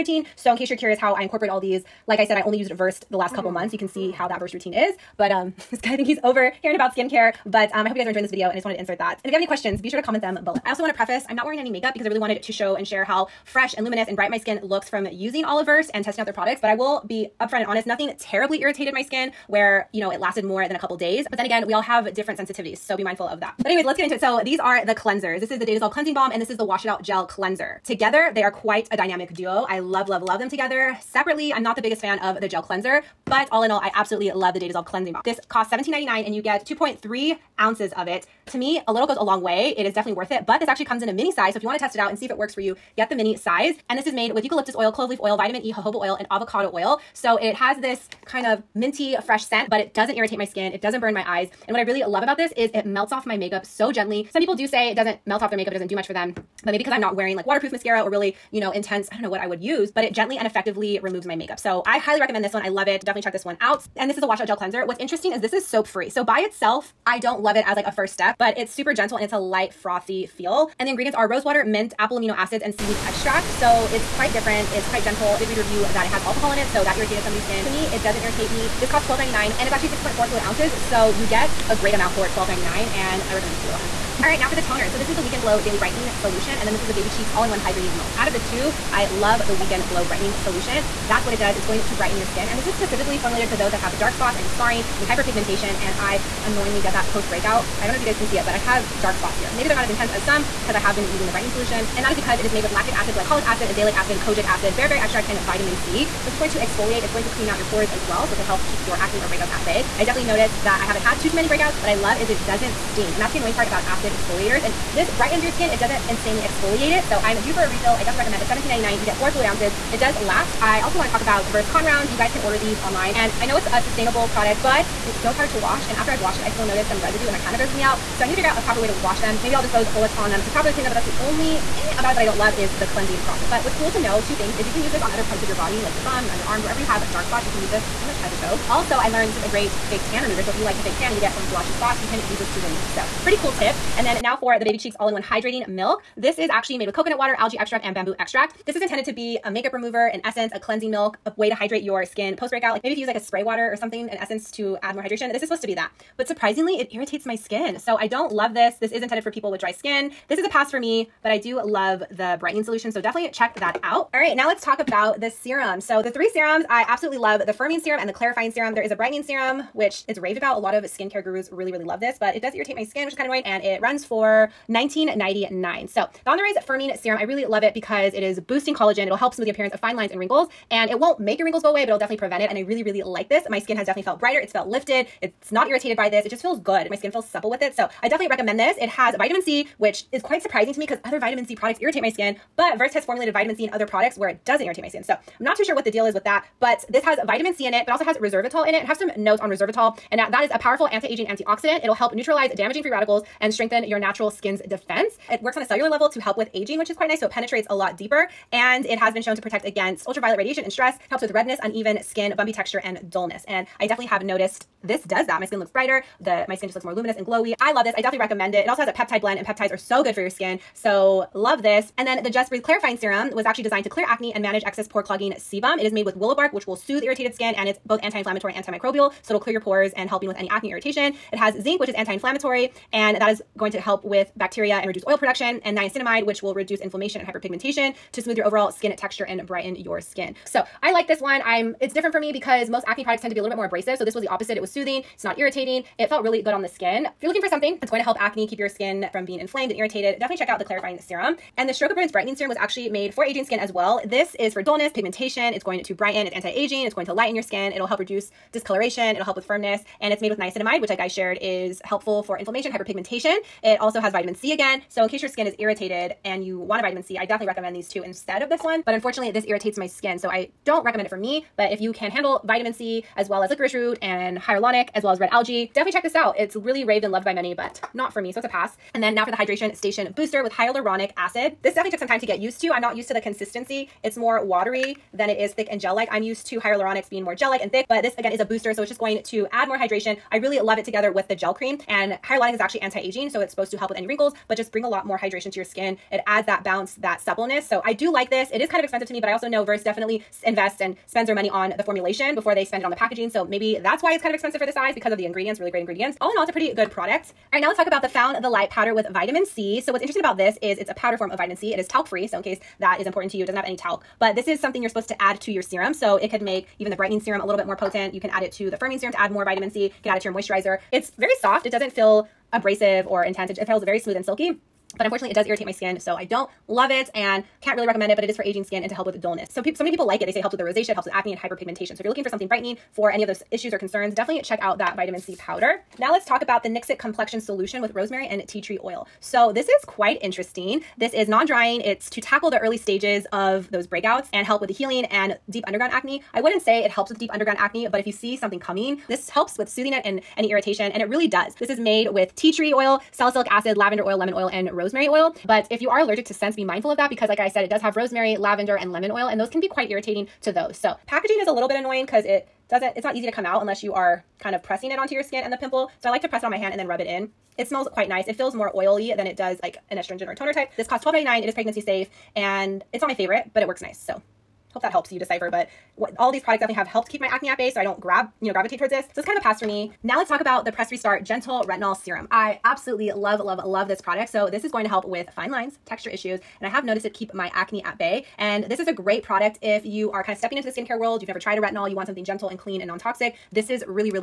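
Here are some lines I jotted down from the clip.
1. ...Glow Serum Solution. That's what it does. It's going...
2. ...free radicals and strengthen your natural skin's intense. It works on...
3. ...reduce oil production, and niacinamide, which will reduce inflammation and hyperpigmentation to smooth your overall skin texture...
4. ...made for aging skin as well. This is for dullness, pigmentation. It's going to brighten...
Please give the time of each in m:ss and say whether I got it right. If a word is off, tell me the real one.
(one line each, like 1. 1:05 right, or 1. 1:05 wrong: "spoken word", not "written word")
1. 1:29 wrong: "Brightening", not "Serum"
2. 3:22 wrong: "defense", not "intense"
3. 3:54 right
4. 4:12 right.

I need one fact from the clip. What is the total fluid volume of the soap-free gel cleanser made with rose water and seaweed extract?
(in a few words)
6.4 fluid ounces.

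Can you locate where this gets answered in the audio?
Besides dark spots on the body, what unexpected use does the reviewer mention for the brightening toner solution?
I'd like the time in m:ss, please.
2:19.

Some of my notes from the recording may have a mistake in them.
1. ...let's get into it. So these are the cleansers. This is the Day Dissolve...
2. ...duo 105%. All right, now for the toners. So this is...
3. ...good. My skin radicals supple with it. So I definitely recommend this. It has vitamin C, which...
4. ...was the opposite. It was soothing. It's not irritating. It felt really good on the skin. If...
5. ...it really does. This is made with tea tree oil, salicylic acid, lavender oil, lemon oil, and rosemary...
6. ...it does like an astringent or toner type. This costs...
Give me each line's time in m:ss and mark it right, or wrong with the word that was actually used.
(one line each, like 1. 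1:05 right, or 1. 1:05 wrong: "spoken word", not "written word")
1. 0:23 right
2. 1:23 wrong: "100", not "105"
3. 3:06 wrong: "feels", not "radicals"
4. 4:04 right
5. 5:51 right
6. 6:09 right.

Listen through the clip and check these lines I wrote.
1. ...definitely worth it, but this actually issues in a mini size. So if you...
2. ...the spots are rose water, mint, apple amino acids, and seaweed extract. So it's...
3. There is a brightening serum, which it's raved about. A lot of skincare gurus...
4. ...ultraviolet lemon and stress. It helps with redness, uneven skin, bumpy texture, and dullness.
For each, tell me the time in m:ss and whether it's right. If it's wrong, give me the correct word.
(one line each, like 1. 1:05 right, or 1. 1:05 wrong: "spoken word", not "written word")
1. 0:39 wrong: "comes", not "issues"
2. 1:10 wrong: "ingredients", not "spots"
3. 2:48 right
4. 3:30 wrong: "radiation", not "lemon".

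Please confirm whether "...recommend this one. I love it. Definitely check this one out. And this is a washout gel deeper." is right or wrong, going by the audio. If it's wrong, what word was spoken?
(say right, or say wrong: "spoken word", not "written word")
wrong: "cleanser", not "deeper".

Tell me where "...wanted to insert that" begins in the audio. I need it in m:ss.
0:08.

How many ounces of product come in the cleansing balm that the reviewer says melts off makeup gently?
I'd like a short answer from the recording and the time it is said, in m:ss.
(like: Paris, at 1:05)
2.3 ounces, at 0:36.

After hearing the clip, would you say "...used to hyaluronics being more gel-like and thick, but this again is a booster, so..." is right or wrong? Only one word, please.
right.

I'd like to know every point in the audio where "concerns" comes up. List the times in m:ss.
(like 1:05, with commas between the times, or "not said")
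5:33.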